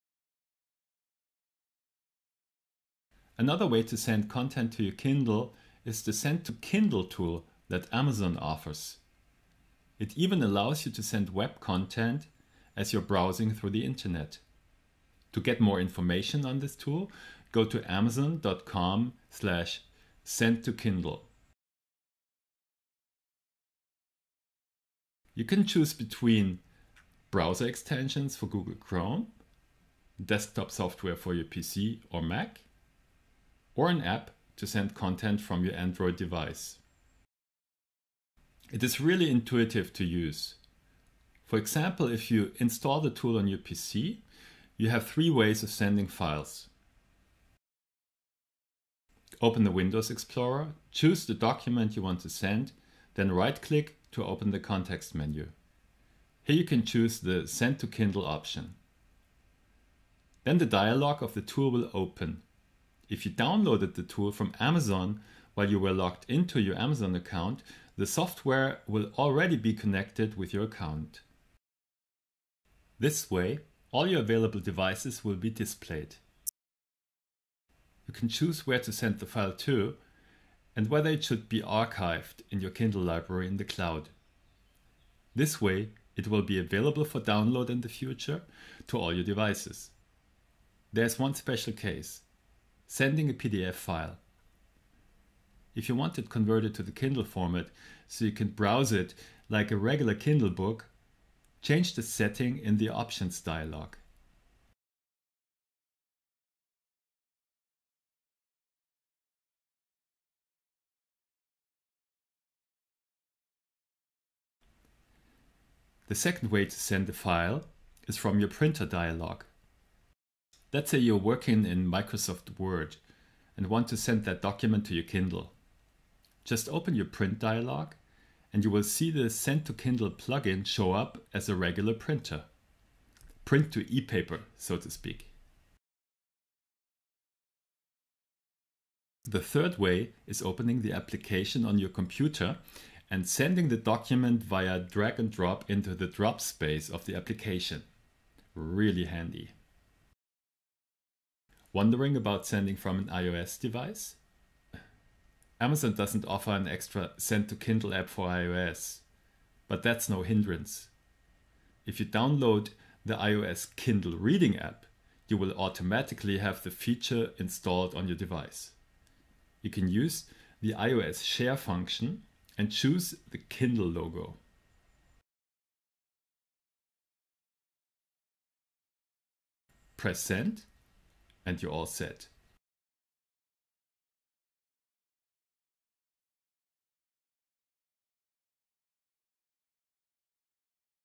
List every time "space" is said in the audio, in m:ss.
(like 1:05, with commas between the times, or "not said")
2:26.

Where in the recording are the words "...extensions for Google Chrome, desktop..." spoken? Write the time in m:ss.
0:27.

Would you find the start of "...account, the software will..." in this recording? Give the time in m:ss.
1:07.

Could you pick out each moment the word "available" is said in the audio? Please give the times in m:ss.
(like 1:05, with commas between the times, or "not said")
1:14, 1:26.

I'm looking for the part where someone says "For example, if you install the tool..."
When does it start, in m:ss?
0:41.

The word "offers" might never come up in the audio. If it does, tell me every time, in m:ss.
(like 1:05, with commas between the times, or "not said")
0:08, 2:36.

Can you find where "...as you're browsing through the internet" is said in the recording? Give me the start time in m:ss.
0:12.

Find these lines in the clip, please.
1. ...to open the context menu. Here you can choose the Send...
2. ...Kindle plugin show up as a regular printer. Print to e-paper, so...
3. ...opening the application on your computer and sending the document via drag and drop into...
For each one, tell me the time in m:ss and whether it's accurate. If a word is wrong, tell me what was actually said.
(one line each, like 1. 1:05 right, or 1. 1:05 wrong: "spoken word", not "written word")
1. 0:54 right
2. 2:09 right
3. 2:20 right.